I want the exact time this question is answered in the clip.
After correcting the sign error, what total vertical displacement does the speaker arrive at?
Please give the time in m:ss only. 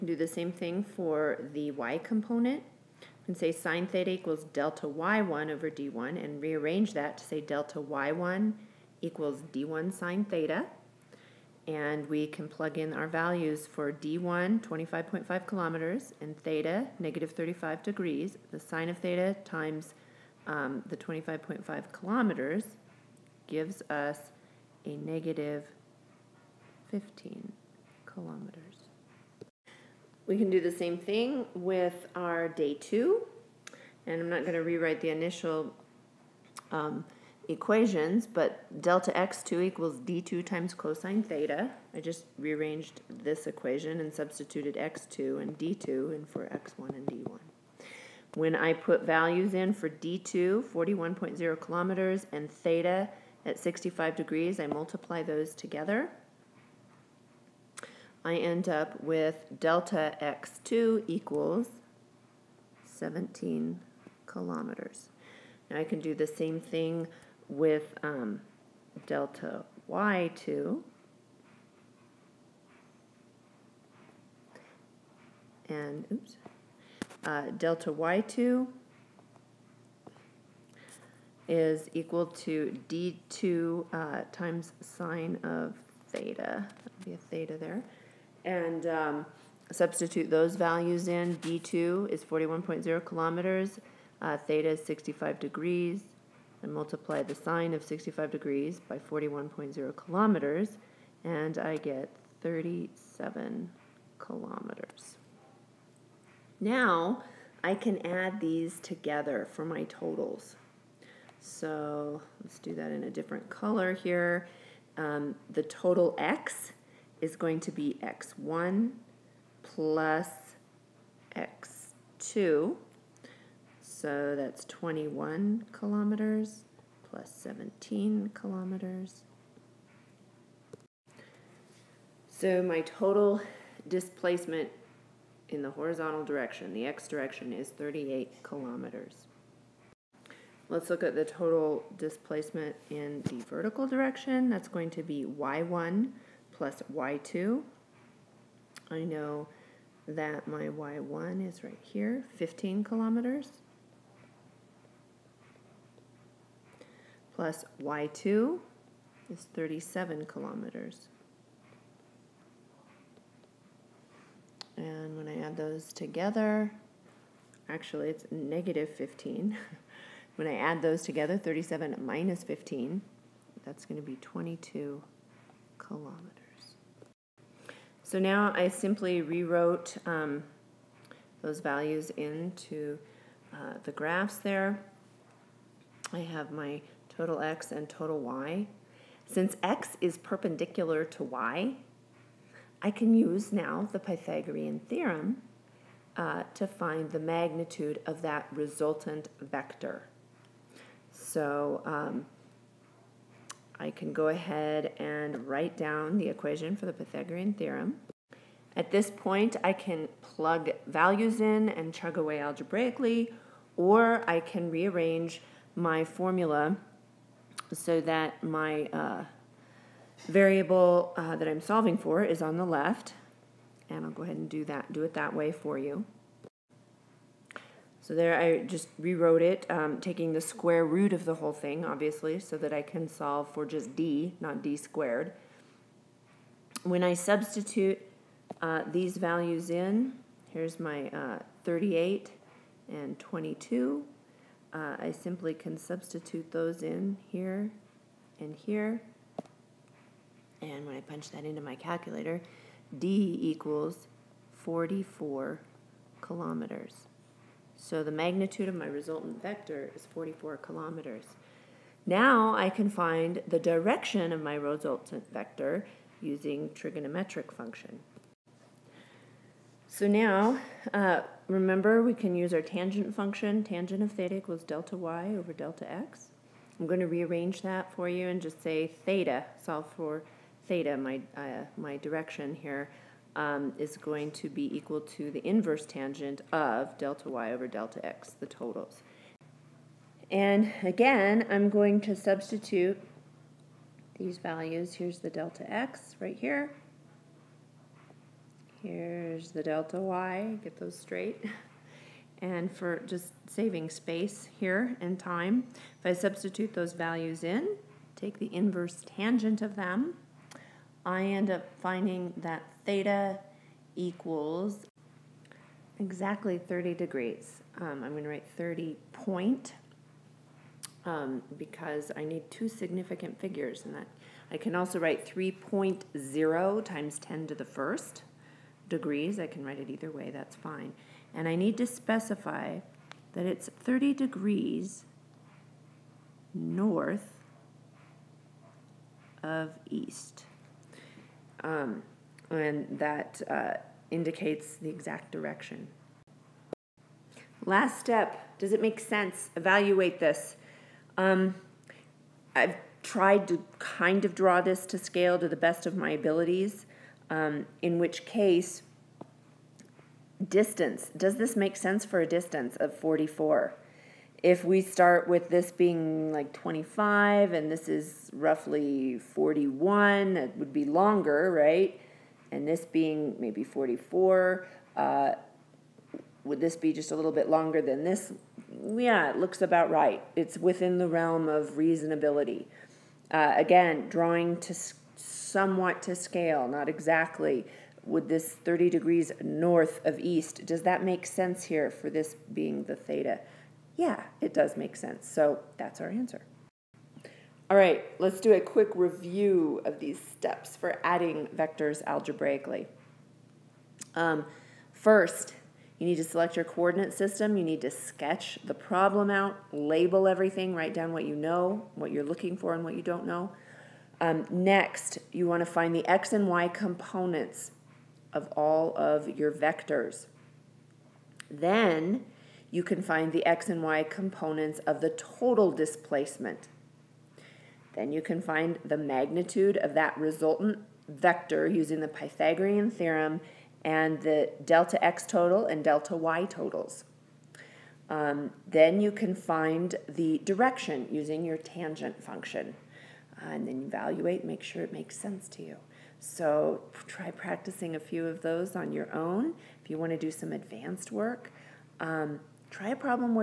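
2:54.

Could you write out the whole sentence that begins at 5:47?
Last step, does it make sense?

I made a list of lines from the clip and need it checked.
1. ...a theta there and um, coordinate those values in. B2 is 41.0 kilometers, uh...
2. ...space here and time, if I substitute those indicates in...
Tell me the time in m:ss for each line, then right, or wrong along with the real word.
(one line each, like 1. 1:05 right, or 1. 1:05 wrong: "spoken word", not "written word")
1. 1:27 wrong: "substitute", not "coordinate"
2. 5:03 wrong: "values", not "indicates".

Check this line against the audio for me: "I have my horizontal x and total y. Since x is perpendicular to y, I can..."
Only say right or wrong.
wrong.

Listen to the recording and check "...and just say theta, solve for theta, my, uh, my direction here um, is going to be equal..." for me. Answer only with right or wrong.
right.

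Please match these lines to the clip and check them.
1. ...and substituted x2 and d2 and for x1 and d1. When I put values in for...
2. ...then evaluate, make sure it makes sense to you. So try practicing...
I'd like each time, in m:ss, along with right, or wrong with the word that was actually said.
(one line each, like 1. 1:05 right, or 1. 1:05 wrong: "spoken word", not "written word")
1. 0:43 right
2. 7:23 right.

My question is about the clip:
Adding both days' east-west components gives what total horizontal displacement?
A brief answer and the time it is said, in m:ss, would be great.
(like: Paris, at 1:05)
38 kilometers, at 2:17.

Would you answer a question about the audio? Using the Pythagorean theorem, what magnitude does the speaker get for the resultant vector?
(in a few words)
44 kilometers.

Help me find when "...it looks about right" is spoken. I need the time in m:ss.
6:19.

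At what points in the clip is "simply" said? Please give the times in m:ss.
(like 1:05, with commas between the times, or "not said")
2:58, 4:05.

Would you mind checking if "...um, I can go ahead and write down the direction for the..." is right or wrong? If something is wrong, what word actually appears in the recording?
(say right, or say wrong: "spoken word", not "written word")
wrong: "equation", not "direction".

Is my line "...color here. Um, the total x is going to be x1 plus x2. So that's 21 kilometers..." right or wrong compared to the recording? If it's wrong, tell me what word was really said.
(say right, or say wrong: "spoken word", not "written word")
right.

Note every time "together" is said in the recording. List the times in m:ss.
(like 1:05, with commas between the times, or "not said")
0:55, 1:48, 2:45, 2:51.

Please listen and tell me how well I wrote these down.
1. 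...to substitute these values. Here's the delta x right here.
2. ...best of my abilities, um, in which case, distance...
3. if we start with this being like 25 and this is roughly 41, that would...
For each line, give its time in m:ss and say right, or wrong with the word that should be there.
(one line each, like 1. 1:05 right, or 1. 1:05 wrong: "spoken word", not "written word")
1. 4:52 right
2. 5:55 right
3. 6:04 right.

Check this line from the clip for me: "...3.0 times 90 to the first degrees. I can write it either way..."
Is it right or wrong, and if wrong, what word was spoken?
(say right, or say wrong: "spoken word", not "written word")
wrong: "10", not "90".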